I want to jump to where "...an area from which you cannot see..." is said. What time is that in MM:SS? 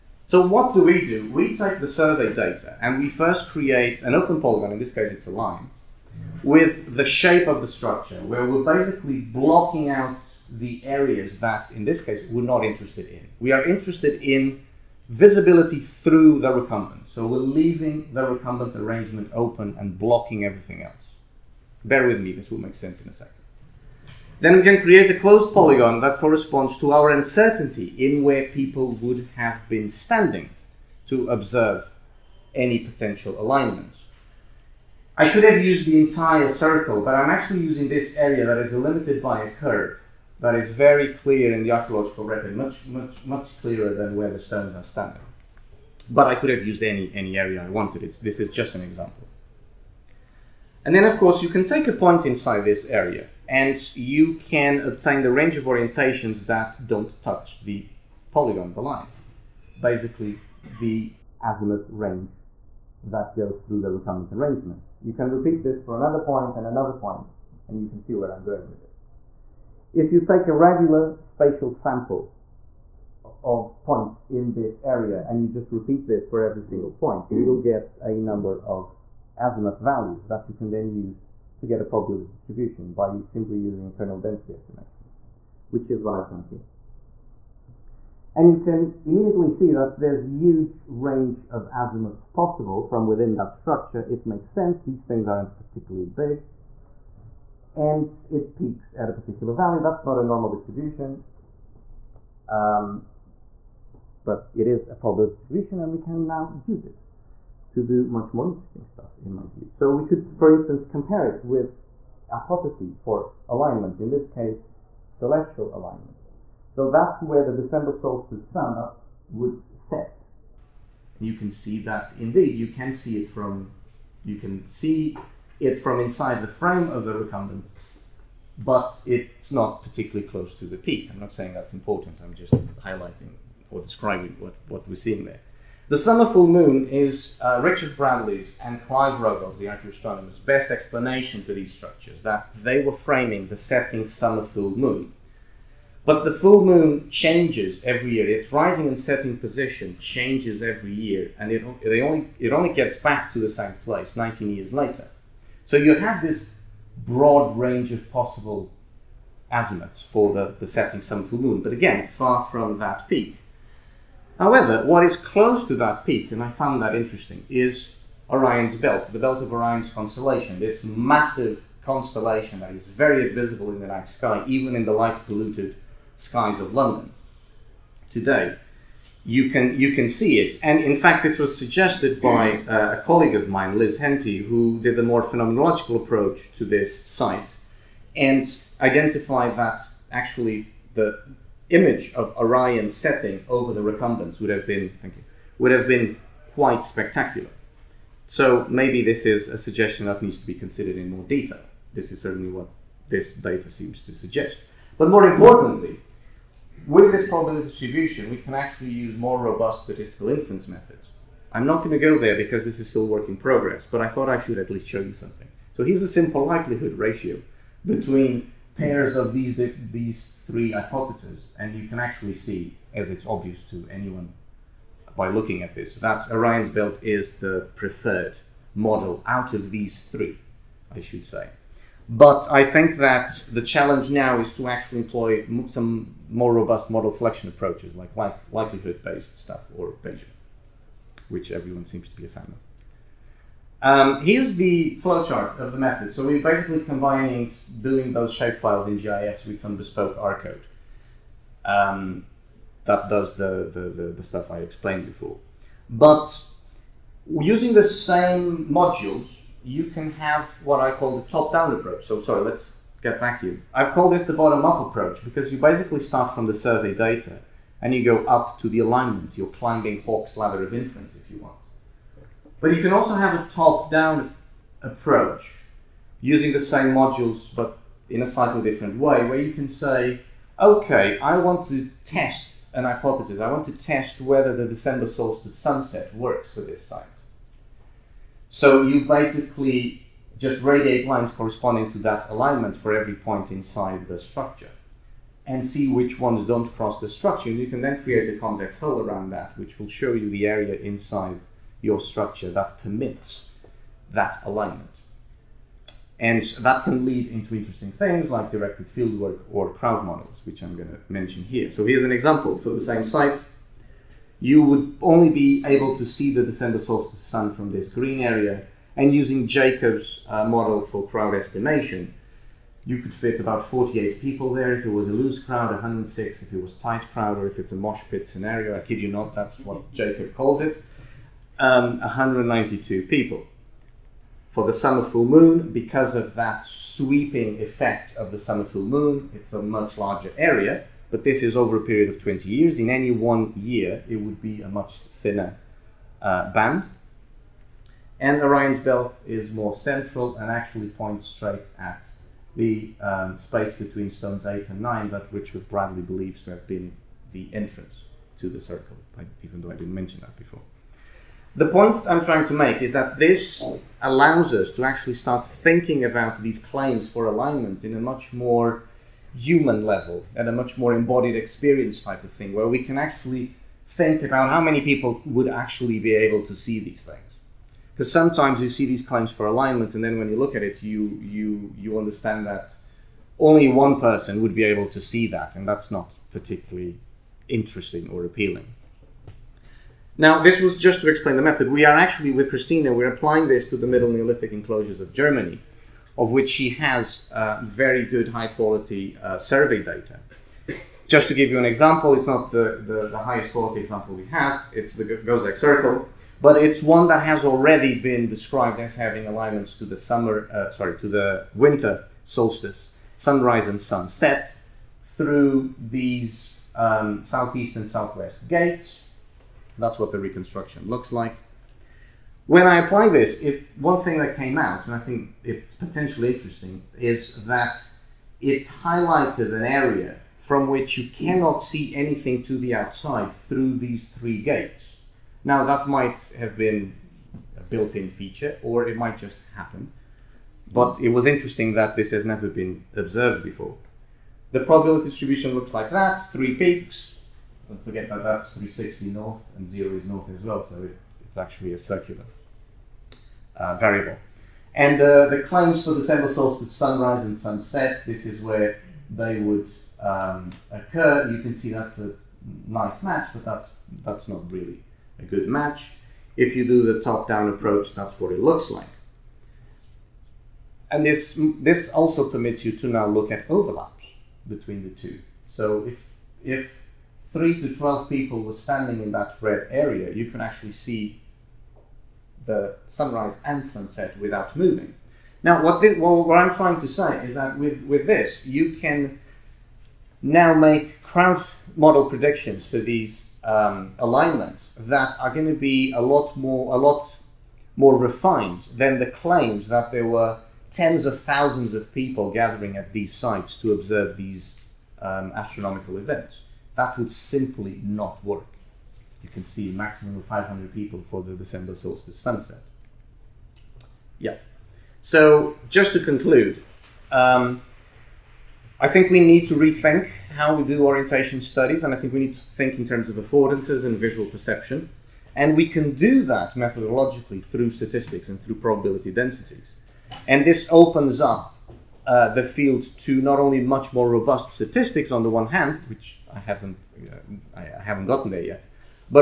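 07:09.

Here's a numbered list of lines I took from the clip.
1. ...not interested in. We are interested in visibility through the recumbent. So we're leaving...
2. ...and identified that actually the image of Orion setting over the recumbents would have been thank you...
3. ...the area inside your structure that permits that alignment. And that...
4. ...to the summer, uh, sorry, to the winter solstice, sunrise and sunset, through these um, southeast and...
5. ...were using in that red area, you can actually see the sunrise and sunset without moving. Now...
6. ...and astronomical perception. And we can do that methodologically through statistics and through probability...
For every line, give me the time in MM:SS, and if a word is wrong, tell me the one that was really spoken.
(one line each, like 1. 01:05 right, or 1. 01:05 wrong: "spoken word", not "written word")
1. 00:12 right
2. 03:08 right
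3. 05:00 right
4. 06:49 right
5. 07:58 wrong: "standing", not "using"
6. 08:43 wrong: "visual", not "astronomical".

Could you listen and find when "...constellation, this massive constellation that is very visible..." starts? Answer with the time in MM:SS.
02:49.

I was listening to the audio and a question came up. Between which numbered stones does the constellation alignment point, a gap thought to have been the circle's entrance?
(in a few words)
Stones 8 and 9.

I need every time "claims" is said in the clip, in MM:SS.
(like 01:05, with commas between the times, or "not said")
06:06, 06:19, 07:35, 08:19.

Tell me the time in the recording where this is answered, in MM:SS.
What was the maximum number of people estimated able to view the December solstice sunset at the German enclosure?
08:30.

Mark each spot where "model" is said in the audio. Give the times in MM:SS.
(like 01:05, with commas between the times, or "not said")
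03:48, 03:56, 05:10, 05:20, 08:11.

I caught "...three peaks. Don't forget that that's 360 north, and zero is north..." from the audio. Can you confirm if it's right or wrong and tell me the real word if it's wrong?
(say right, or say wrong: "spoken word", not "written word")
right.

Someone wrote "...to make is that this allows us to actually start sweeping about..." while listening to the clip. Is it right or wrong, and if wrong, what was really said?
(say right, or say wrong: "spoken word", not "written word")
wrong: "thinking", not "sweeping".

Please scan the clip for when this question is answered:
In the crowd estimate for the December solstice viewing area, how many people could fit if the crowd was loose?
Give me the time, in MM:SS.
05:23.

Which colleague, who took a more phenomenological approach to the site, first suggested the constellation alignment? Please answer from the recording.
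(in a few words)
Liz Henty.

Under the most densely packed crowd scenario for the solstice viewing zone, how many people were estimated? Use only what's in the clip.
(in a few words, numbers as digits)
192.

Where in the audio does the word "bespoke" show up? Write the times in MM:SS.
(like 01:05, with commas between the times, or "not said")
04:09.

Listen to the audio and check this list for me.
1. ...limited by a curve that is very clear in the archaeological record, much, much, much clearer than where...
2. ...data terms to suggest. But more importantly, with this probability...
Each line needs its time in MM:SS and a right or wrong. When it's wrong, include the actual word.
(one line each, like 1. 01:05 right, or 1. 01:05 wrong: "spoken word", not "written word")
1. 00:38 right
2. 03:23 wrong: "seems", not "terms".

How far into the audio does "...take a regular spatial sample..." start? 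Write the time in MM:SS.
01:10.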